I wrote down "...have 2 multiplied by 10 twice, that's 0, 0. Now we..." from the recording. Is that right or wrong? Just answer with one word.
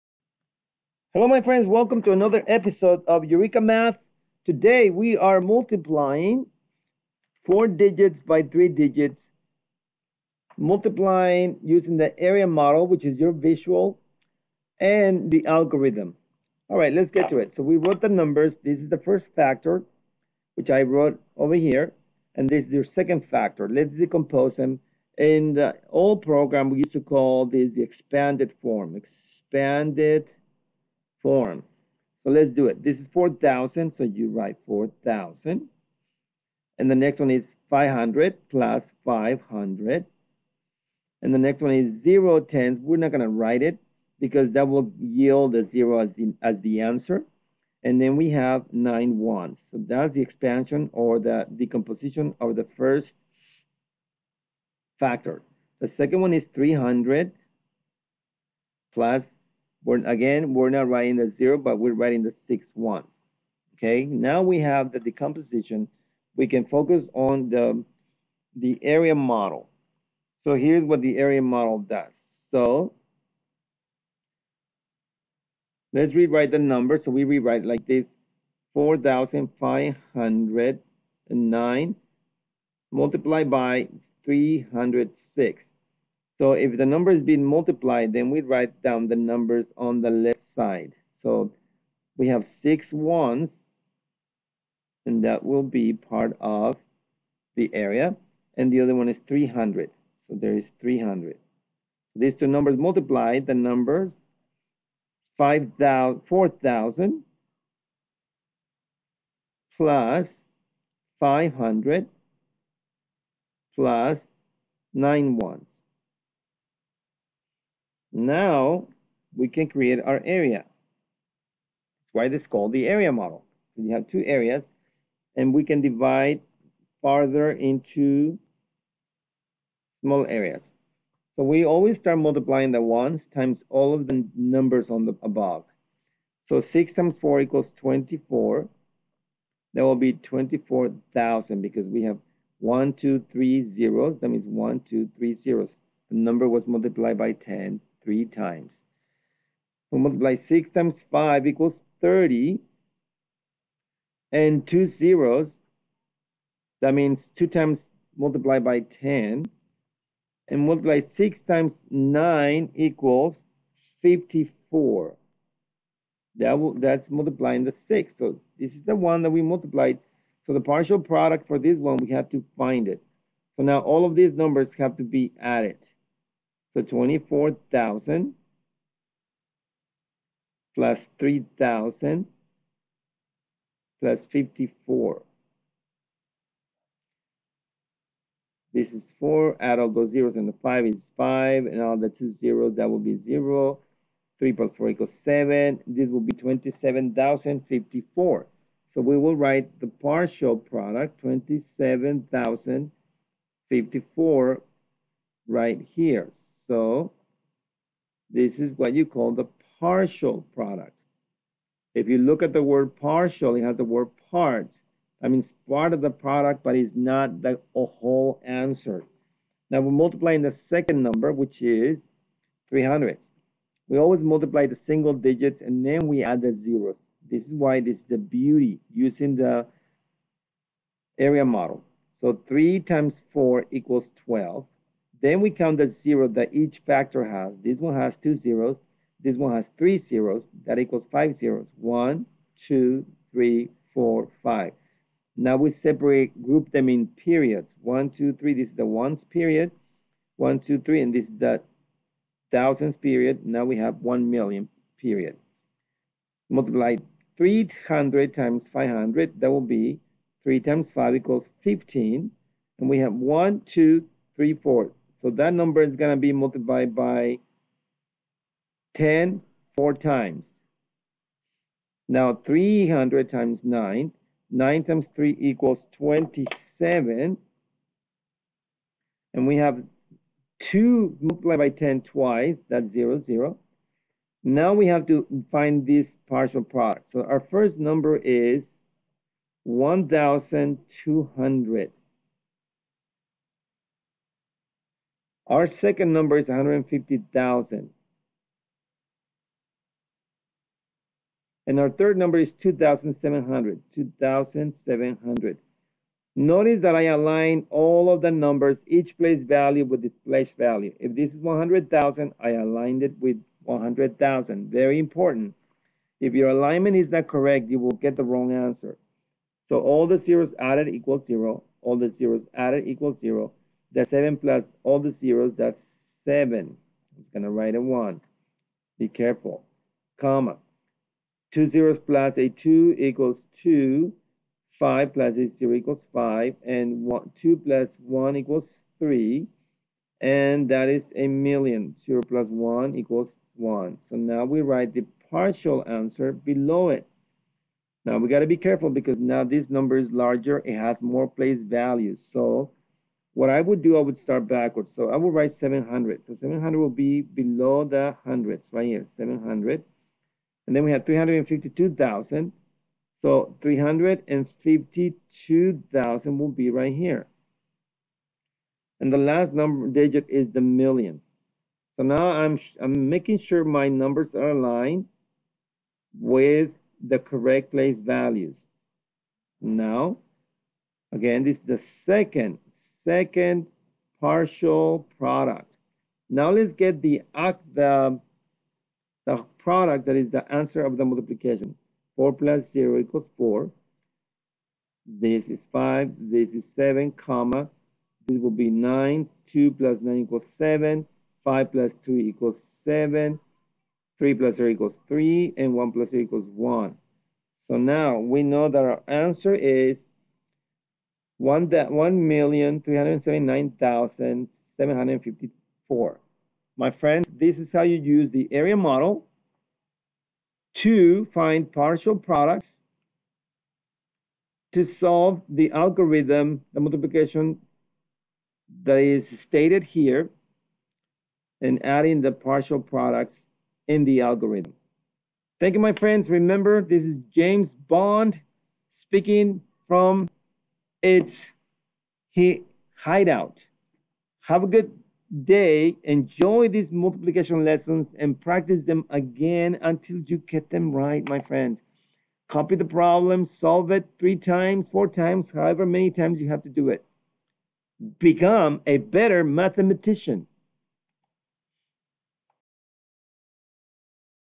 right.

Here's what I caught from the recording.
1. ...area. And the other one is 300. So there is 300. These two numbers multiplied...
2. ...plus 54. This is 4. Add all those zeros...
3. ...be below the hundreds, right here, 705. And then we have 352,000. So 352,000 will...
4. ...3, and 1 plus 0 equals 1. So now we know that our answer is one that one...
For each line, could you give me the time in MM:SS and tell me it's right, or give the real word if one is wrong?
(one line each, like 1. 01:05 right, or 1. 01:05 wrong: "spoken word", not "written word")
1. 01:37 right
2. 03:03 right
3. 05:56 wrong: "700", not "705"
4. 06:45 right.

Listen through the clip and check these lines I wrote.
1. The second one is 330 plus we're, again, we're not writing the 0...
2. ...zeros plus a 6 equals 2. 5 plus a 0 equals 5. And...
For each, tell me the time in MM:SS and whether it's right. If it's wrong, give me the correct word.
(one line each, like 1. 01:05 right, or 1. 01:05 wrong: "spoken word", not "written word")
1. 00:55 wrong: "300", not "330"
2. 05:31 wrong: "2", not "6".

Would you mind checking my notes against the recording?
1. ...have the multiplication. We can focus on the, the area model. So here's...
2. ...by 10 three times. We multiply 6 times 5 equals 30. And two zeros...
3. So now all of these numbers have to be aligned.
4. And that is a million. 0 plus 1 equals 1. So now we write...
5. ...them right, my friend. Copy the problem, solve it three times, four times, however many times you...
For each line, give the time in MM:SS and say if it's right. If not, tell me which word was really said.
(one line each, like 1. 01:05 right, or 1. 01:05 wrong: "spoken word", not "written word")
1. 01:04 wrong: "decomposition", not "multiplication"
2. 02:27 right
3. 02:53 wrong: "added", not "aligned"
4. 05:40 right
5. 07:30 right.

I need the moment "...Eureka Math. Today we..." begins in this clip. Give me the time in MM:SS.
00:03.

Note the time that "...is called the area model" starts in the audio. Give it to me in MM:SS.
02:02.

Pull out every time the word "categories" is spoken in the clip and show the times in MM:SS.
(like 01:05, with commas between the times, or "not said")
not said.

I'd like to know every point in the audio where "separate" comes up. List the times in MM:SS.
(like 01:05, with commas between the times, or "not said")
04:05.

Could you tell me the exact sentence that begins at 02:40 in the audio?
And multiply 6 times 9 equals 54.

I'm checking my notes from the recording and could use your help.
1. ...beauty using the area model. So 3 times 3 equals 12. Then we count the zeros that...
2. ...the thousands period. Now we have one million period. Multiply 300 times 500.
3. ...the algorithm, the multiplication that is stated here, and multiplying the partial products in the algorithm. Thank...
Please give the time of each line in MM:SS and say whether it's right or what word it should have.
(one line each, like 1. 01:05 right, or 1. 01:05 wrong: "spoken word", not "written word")
1. 03:48 wrong: "4", not "3"
2. 04:11 right
3. 07:05 wrong: "adding", not "multiplying".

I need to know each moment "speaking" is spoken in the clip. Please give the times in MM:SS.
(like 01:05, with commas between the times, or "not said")
07:19.